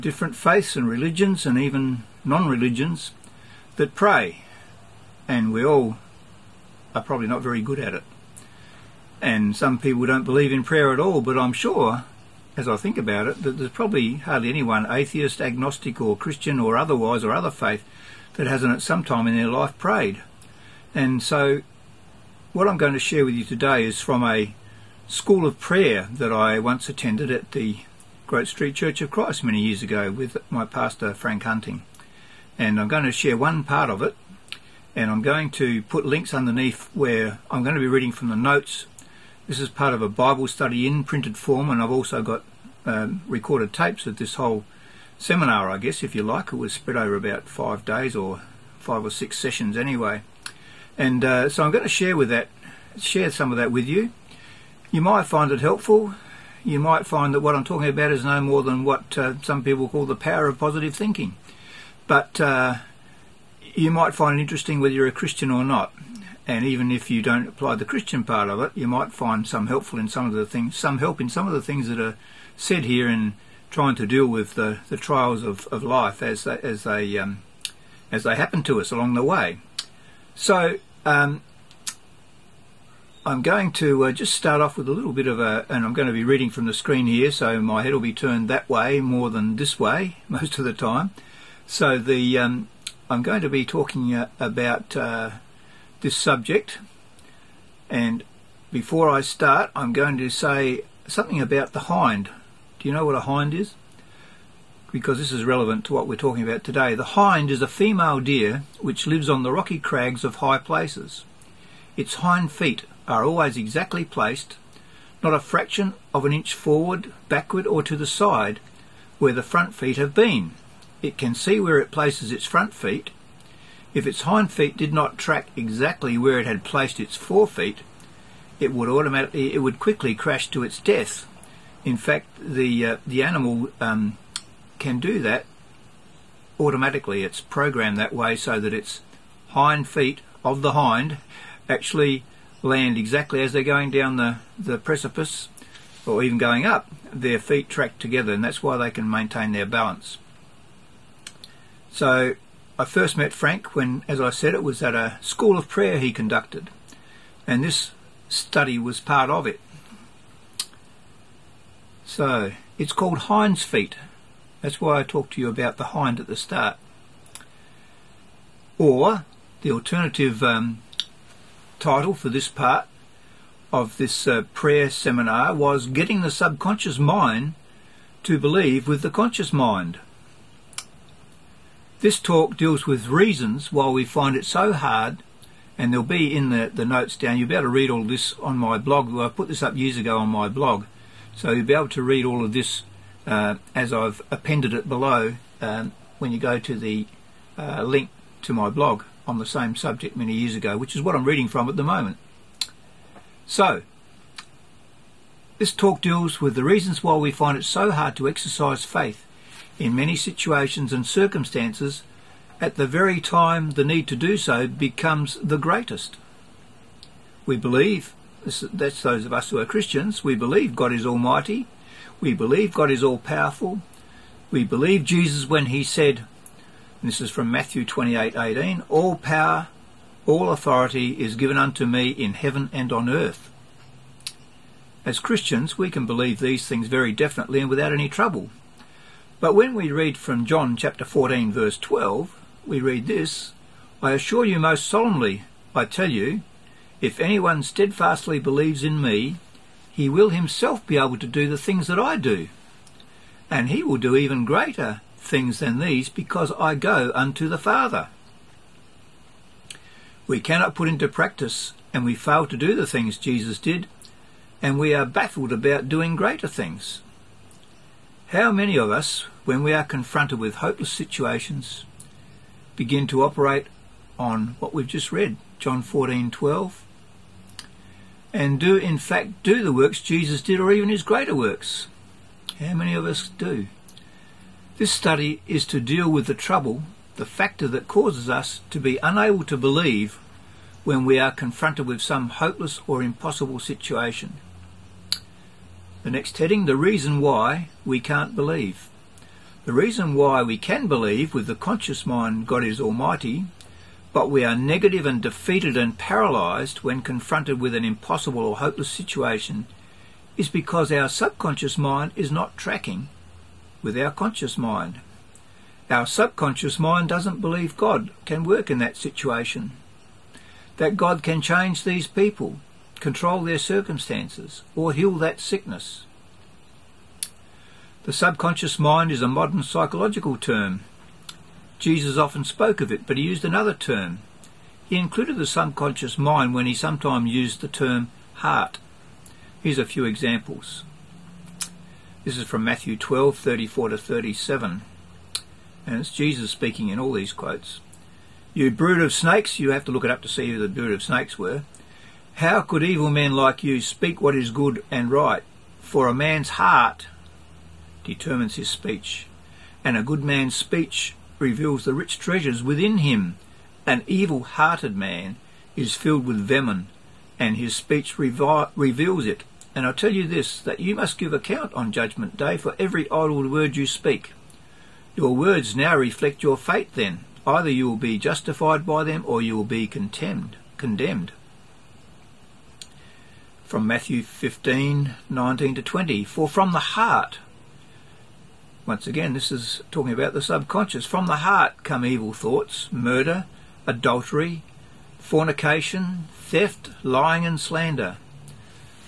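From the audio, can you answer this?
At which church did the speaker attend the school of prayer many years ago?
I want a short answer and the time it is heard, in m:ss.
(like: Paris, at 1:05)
Great Street Church of Christ, at 0:28.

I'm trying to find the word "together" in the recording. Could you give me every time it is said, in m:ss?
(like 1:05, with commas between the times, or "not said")
2:27.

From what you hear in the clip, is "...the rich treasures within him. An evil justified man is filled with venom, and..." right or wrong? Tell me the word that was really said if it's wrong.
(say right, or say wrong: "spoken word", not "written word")
wrong: "hearted", not "justified".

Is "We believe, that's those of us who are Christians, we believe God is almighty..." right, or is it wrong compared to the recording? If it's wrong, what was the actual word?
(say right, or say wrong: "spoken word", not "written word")
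right.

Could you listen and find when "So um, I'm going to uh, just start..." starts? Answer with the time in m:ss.
1:20.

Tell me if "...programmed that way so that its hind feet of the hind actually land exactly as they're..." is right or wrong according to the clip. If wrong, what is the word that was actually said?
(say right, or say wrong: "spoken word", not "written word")
right.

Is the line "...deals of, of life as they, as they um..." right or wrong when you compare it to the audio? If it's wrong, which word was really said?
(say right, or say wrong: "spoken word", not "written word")
wrong: "trials", not "deals".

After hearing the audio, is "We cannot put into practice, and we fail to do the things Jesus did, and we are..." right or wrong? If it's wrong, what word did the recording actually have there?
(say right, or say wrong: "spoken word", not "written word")
right.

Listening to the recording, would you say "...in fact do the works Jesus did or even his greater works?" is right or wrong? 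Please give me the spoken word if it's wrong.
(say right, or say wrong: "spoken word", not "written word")
right.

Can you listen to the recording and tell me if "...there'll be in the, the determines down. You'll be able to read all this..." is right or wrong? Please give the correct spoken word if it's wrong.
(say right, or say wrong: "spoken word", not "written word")
wrong: "notes", not "determines".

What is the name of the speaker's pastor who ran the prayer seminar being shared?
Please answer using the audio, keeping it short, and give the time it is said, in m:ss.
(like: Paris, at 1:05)
Frank Hunting, at 0:31.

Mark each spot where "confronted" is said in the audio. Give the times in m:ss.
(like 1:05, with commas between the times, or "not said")
4:29, 4:51, 5:06.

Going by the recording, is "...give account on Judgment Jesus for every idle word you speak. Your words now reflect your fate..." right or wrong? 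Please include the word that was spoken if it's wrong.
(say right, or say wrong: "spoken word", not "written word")
wrong: "Day", not "Jesus".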